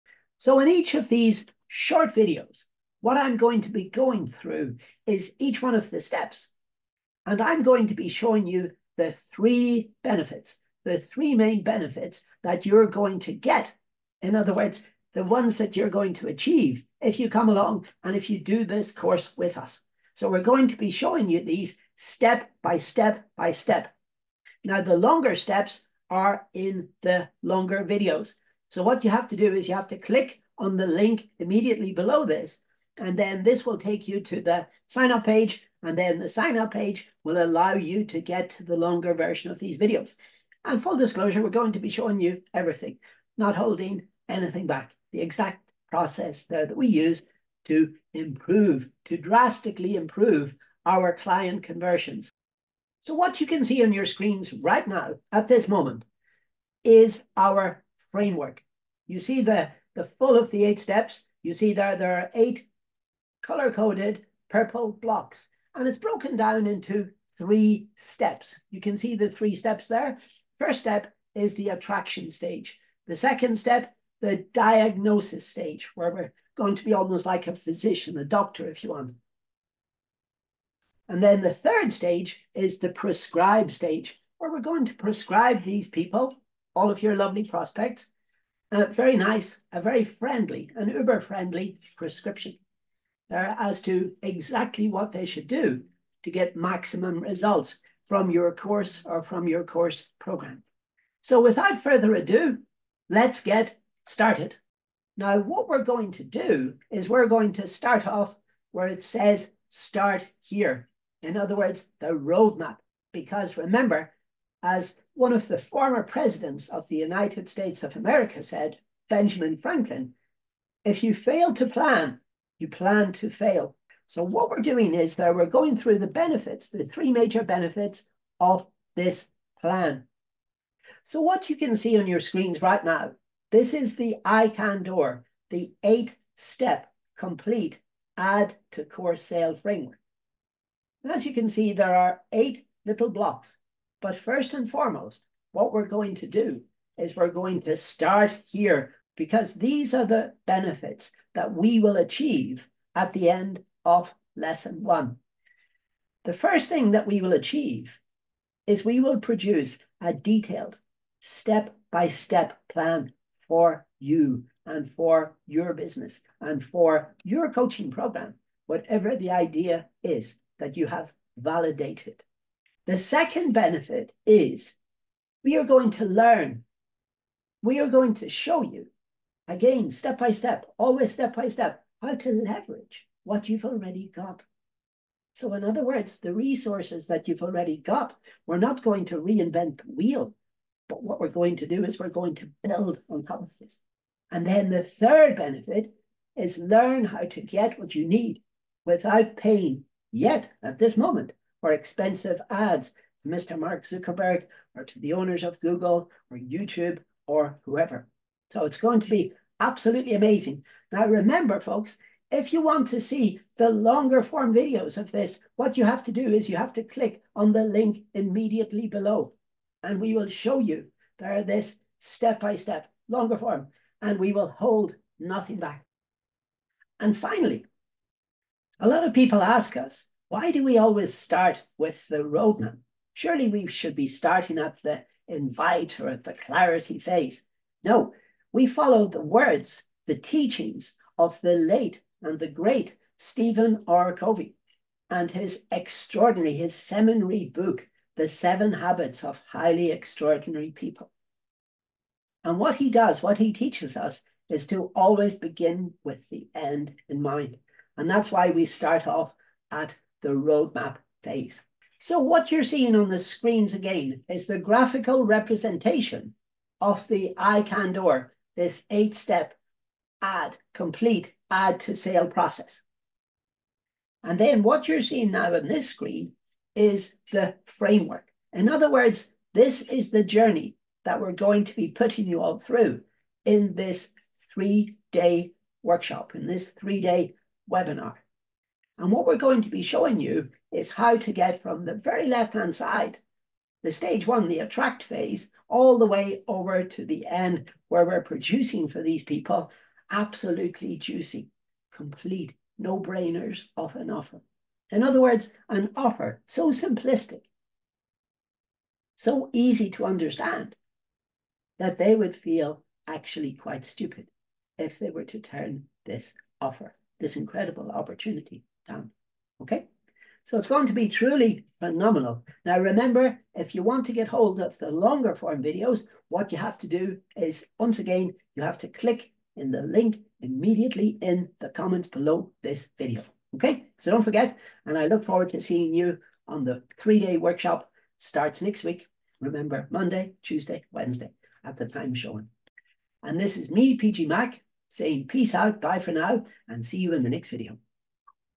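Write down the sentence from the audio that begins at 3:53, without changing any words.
Surely we should be starting at the invite or at the clarity phase.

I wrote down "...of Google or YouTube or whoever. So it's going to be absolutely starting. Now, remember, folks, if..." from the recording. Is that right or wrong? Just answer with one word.
wrong.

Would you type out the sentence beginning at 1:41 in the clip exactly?
So without further ado, let's get started.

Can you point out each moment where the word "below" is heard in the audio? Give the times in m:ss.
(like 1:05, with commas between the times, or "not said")
0:31, 3:38, 5:32.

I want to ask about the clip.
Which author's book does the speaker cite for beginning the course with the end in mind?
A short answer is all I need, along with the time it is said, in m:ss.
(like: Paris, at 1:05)
Stephen R. Covey, at 4:03.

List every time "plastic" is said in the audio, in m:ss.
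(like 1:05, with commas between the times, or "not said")
not said.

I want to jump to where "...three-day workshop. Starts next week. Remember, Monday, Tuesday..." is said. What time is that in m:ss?
5:36.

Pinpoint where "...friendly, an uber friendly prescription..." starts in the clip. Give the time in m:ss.
1:30.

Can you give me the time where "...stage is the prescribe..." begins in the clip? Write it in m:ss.
1:21.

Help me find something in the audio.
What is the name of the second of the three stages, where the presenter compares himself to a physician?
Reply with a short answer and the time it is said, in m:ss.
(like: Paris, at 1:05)
Diagnosis stage, at 1:14.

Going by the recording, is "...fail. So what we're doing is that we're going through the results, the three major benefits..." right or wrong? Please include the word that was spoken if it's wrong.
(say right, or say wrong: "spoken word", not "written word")
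wrong: "benefits", not "results".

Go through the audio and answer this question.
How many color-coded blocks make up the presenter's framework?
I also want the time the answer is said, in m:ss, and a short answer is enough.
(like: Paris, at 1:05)
8, at 1:02.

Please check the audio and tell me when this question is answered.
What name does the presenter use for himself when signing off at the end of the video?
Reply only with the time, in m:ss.
5:43.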